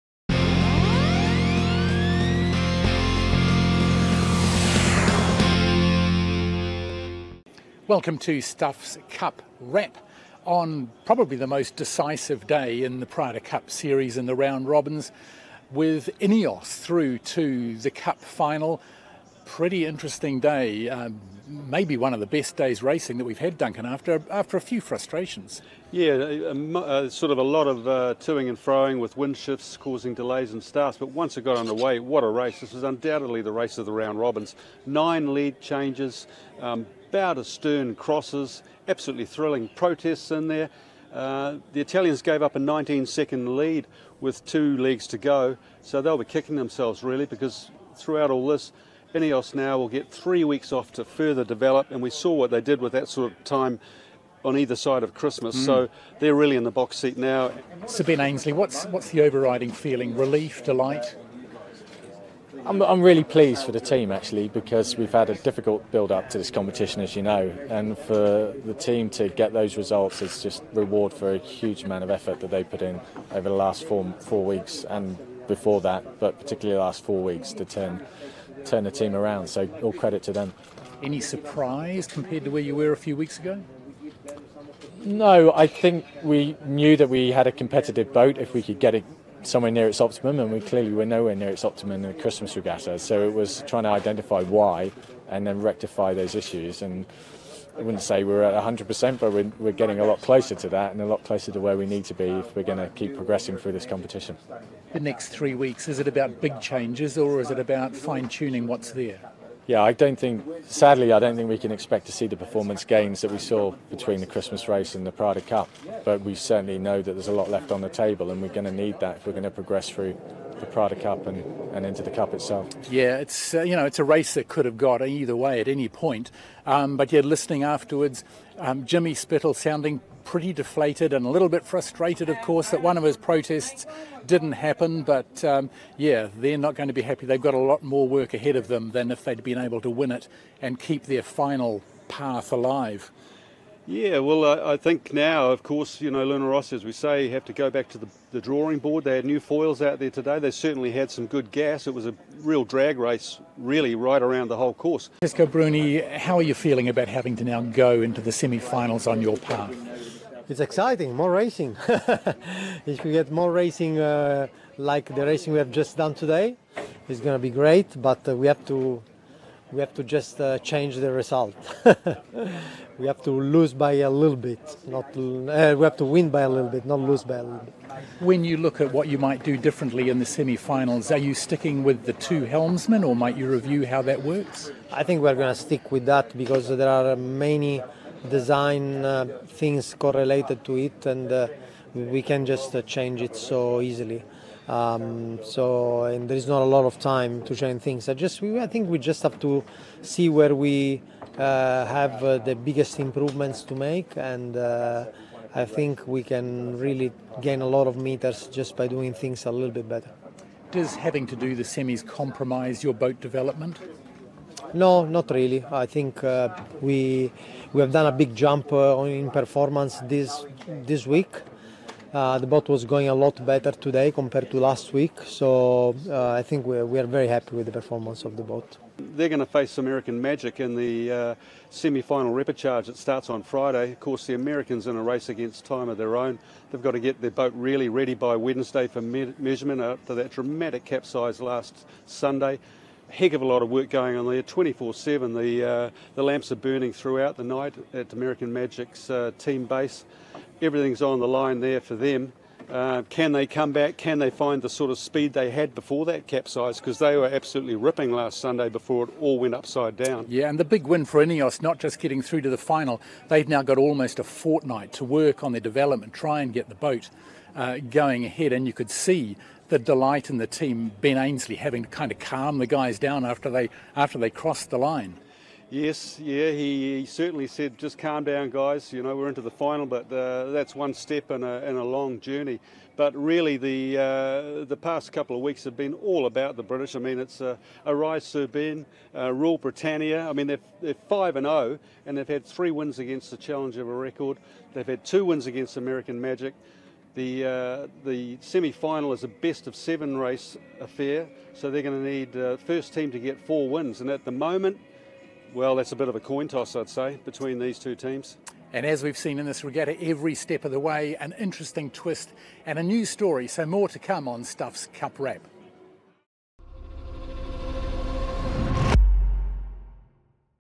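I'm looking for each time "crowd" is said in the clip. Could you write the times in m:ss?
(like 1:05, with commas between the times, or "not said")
not said.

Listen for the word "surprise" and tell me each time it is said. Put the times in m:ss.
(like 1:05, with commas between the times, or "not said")
1:21.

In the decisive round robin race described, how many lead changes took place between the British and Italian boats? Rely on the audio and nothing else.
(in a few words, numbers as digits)
9.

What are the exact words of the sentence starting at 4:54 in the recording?
They've had two wins against American Magic.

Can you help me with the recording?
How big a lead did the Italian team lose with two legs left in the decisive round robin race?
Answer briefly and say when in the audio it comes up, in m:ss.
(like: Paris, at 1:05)
19 seconds, at 0:42.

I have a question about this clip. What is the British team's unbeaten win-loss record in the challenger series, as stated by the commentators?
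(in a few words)
5 and 0.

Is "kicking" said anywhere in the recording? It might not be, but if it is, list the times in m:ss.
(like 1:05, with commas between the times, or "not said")
0:46.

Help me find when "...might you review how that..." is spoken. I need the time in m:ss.
3:03.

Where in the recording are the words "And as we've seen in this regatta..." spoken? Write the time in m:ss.
5:08.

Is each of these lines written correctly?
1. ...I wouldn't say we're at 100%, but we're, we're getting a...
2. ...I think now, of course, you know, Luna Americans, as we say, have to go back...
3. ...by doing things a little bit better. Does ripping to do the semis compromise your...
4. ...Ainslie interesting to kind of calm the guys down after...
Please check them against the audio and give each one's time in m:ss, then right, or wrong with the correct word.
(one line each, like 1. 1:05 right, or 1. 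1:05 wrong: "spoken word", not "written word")
1. 1:37 right
2. 2:24 wrong: "Rossa", not "Americans"
3. 3:28 wrong: "having", not "ripping"
4. 4:31 wrong: "having", not "interesting".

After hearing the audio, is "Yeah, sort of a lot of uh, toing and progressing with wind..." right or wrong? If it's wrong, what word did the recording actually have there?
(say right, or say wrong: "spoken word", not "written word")
wrong: "froing", not "progressing".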